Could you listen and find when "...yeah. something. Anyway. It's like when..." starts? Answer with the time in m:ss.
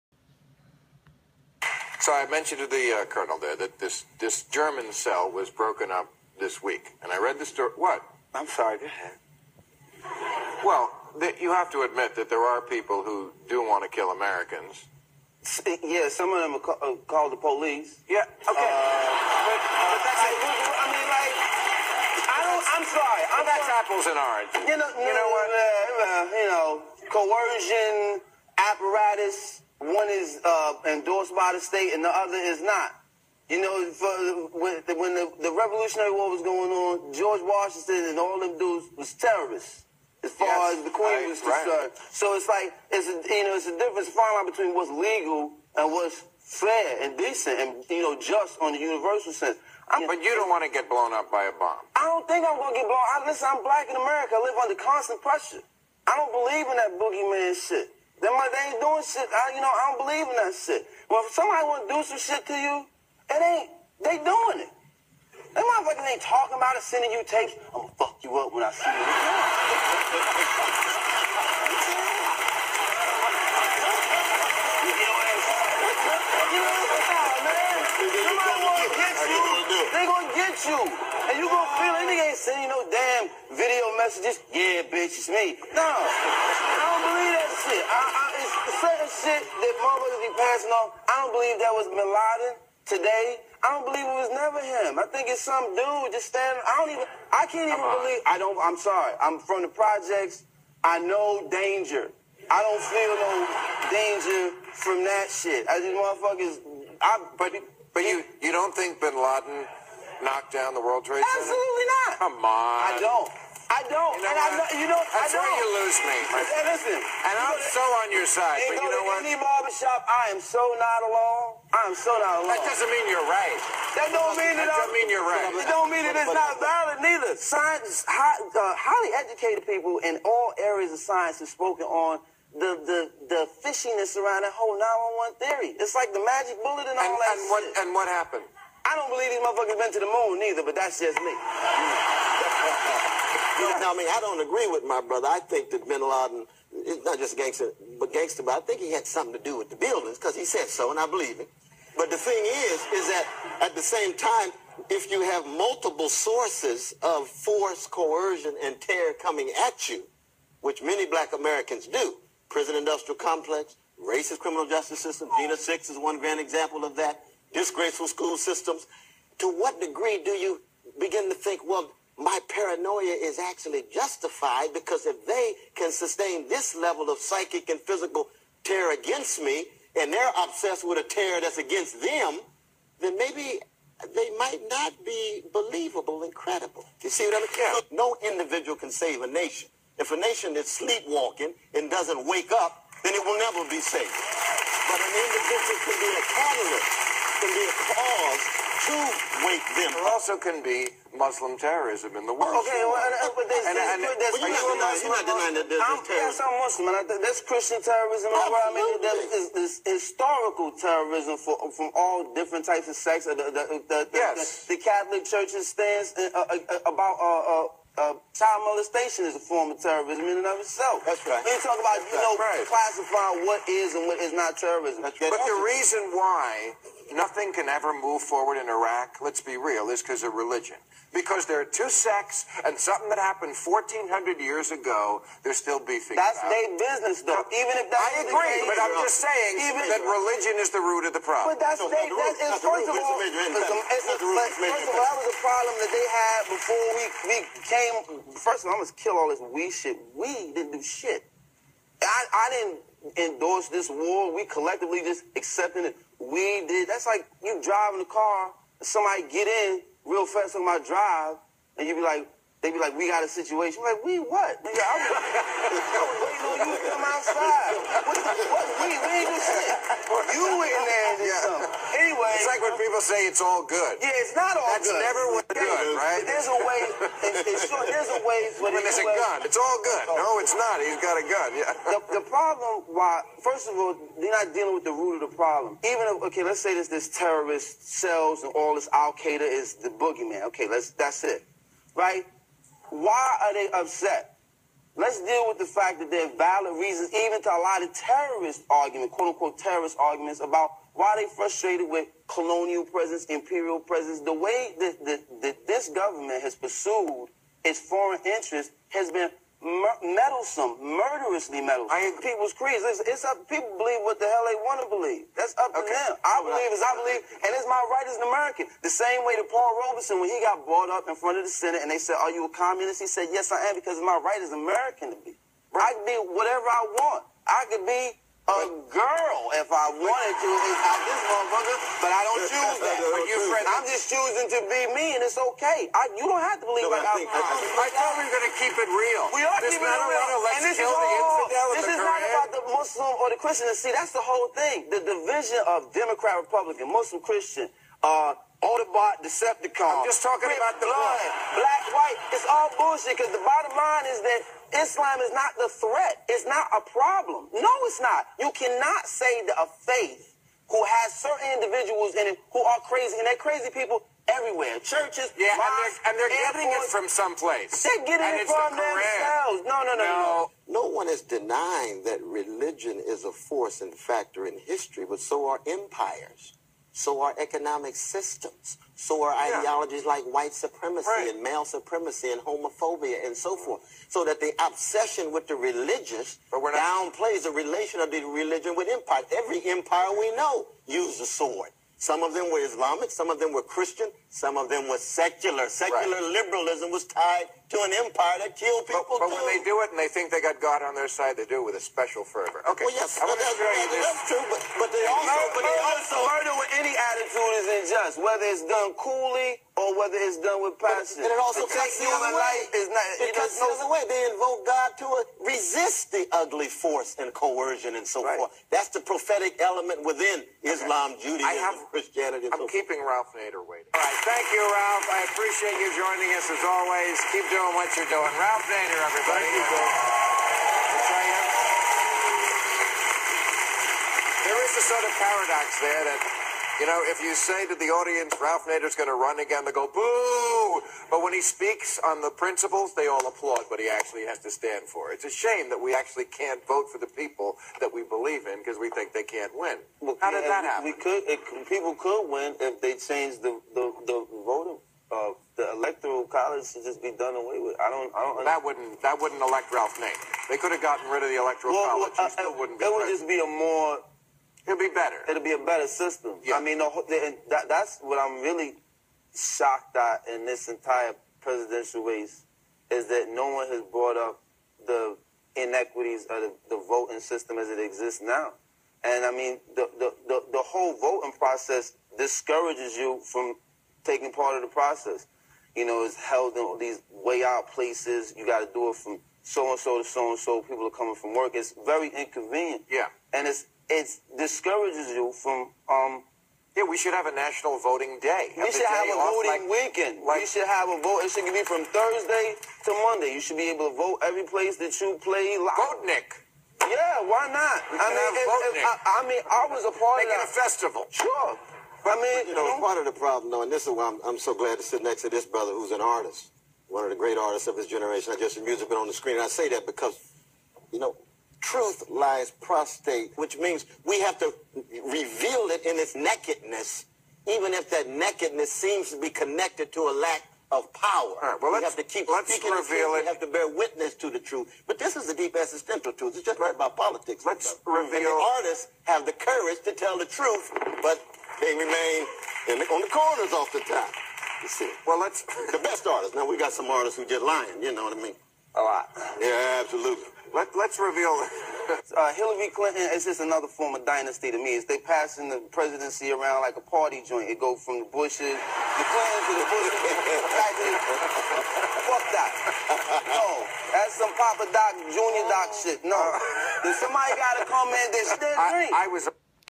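4:31.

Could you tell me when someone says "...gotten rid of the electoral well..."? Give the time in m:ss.
7:40.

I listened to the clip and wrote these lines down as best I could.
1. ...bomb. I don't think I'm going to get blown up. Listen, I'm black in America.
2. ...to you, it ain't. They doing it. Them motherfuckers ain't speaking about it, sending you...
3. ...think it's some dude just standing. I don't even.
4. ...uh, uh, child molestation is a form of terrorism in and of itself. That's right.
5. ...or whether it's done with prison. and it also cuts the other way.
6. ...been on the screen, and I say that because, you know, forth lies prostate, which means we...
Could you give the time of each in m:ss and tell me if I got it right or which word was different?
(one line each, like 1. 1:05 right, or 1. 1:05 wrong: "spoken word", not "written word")
1. 0:51 right
2. 1:02 wrong: "talking", not "speaking"
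3. 1:35 right
4. 3:37 right
5. 6:49 wrong: "passion", not "prison"
6. 8:38 wrong: "truth", not "forth".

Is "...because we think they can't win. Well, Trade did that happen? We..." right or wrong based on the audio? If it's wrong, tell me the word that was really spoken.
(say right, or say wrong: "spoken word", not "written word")
wrong: "How", not "Trade".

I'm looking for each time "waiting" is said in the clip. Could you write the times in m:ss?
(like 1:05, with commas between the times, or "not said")
4:25, 7:03.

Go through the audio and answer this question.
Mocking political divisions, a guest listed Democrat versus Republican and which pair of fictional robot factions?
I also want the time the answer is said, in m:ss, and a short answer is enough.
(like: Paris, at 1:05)
Autobot, Decepticon, at 5:48.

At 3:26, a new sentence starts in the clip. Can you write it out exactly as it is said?
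Yes, I'm Muslim, and I, there's Christian terrorism I mean, there's, there's, there's historical terrorism for, from all different types of sects.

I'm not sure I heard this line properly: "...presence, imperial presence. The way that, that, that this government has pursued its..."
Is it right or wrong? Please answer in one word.
right.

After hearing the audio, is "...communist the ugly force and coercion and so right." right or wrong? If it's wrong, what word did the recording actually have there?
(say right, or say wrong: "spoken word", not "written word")
wrong: "resist", not "communist".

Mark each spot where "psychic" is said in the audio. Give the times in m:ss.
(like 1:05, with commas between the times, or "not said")
2:57.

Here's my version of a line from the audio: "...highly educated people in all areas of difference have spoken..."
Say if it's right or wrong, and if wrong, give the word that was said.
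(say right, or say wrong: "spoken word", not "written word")
wrong: "science", not "difference".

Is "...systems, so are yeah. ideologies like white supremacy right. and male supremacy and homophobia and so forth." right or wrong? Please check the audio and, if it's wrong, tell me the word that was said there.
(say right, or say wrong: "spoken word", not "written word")
right.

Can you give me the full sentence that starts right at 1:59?
Any barbershop, I am so not alone.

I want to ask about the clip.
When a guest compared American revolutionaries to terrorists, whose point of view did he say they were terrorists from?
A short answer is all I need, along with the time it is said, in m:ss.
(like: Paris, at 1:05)
The Queen, at 0:40.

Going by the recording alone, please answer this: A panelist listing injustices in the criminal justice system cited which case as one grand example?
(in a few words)
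Jena Six.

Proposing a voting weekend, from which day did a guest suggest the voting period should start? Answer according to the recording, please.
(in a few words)
Thursday.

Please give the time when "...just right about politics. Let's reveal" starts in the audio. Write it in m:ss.
8:56.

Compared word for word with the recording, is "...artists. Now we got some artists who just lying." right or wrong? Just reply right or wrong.
right.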